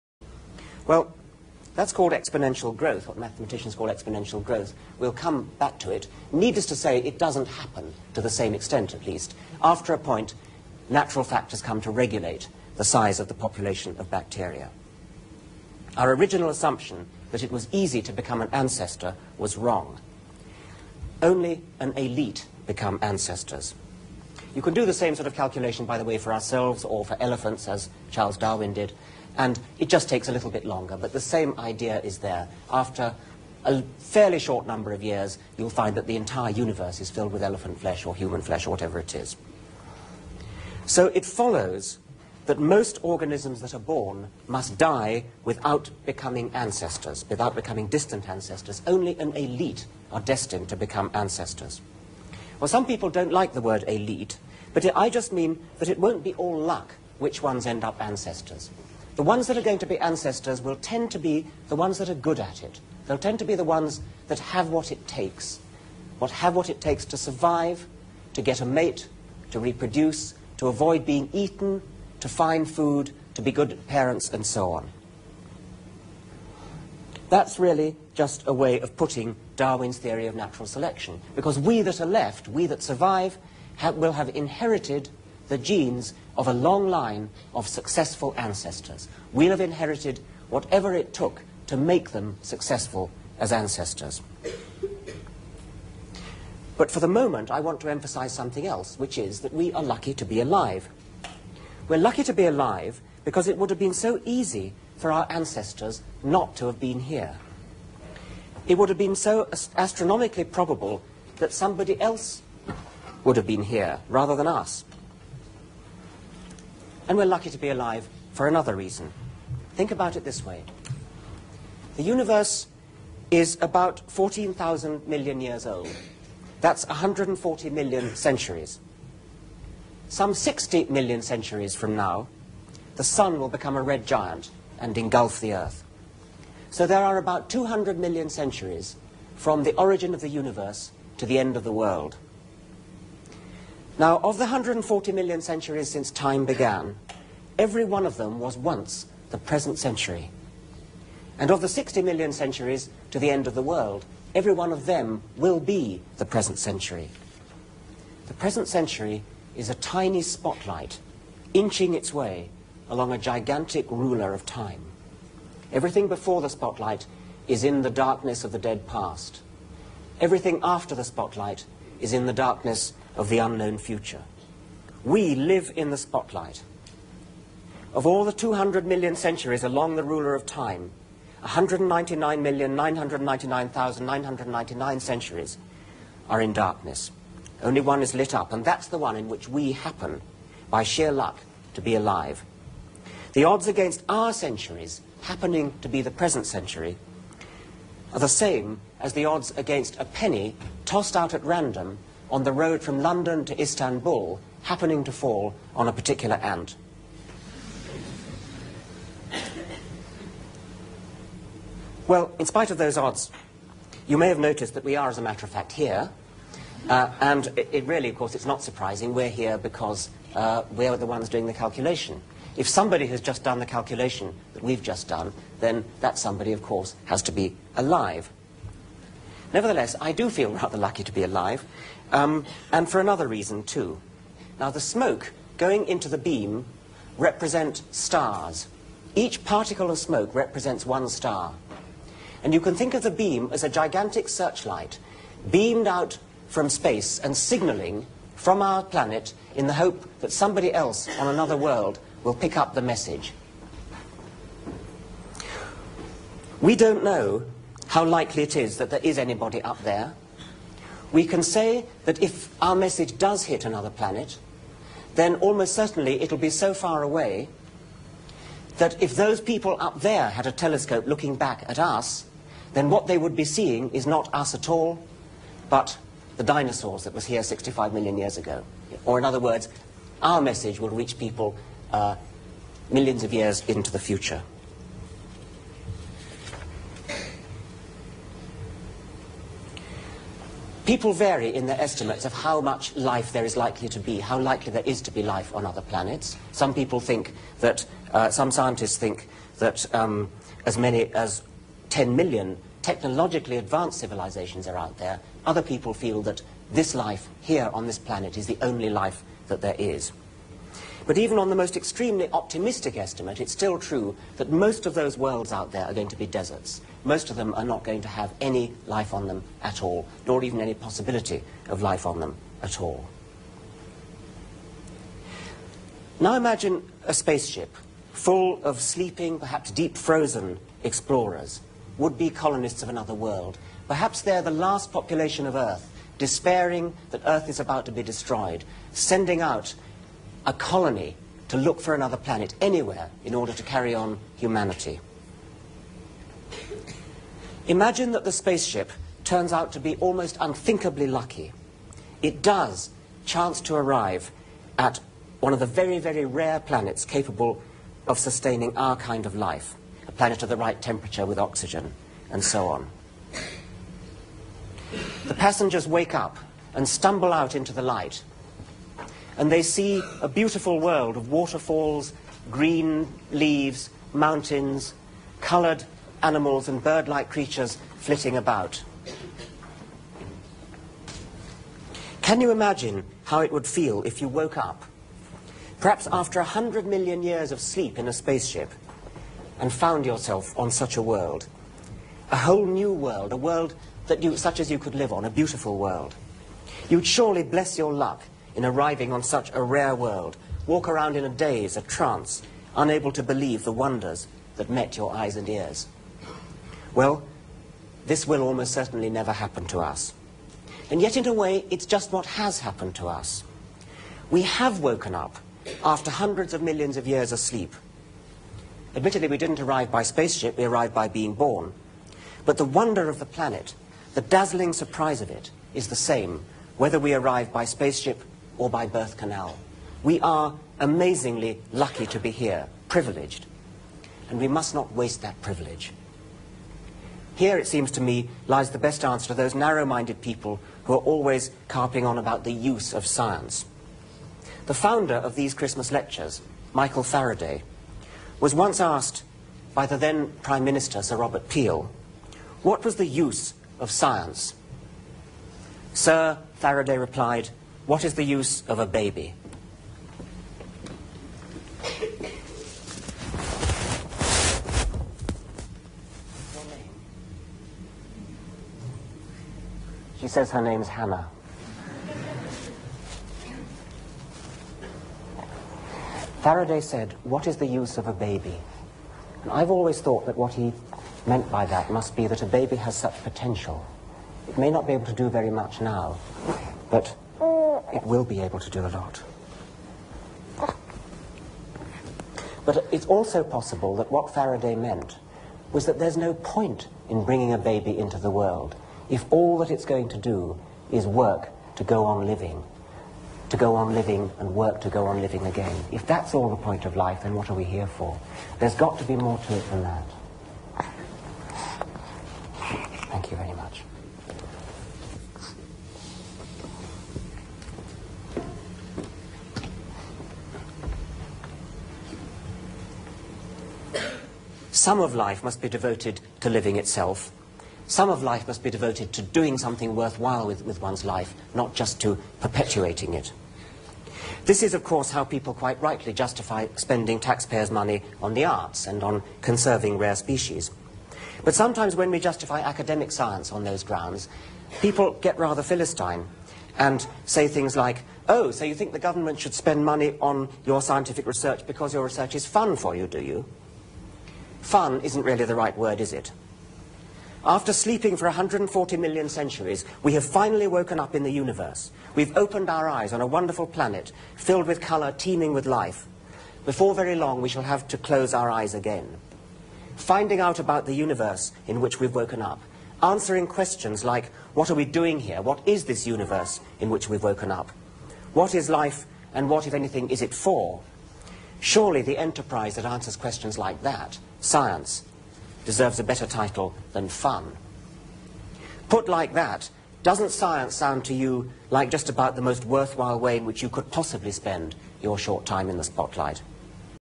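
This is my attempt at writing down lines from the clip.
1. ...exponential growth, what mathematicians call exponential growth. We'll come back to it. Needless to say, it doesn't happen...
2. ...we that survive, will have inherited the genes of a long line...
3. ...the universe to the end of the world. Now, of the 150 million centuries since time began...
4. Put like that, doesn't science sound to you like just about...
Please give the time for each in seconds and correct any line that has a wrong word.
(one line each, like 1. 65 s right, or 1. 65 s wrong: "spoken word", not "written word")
1. 2 s right
2. 82 s right
3. 140 s wrong: "140", not "150"
4. 588 s right.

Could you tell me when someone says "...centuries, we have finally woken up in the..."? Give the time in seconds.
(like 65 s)
559 s.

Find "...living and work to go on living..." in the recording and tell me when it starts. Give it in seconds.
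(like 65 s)
503 s.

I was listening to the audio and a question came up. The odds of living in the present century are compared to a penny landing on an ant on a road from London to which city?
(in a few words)
Istanbul.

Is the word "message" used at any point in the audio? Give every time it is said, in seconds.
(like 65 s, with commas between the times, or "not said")
252 s, 262 s, 280 s.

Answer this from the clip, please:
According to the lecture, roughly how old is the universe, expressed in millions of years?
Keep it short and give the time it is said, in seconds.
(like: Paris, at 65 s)
14,000 million years, at 124 s.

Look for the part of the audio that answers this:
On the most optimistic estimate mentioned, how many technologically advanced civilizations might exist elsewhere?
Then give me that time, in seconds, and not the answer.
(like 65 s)
301 s.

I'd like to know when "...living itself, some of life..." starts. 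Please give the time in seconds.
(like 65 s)
526 s.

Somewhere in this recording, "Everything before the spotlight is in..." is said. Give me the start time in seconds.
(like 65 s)
165 s.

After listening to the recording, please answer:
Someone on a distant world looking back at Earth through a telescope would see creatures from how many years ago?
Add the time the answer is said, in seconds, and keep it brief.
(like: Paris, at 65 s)
65 million years, at 277 s.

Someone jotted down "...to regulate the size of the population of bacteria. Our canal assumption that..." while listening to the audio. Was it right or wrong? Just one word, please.
wrong.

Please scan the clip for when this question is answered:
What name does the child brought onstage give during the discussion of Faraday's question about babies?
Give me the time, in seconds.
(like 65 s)
470 s.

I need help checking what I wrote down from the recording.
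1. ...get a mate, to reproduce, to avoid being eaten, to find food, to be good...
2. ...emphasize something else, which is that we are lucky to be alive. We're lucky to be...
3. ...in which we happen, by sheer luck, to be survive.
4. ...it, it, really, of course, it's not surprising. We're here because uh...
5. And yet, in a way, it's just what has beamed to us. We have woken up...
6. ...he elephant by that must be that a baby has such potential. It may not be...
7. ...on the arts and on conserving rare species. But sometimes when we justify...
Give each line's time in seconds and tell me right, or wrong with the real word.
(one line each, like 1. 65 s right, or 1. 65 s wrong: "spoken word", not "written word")
1. 68 s right
2. 97 s right
3. 189 s wrong: "alive", not "survive"
4. 217 s right
5. 410 s wrong: "happened", not "beamed"
6. 480 s wrong: "meant", not "elephant"
7. 538 s right.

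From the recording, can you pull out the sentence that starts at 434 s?
And we must not waste that privilege.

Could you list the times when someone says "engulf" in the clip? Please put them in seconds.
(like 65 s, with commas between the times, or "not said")
134 s.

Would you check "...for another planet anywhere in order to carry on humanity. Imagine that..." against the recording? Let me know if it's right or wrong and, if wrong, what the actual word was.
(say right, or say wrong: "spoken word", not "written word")
right.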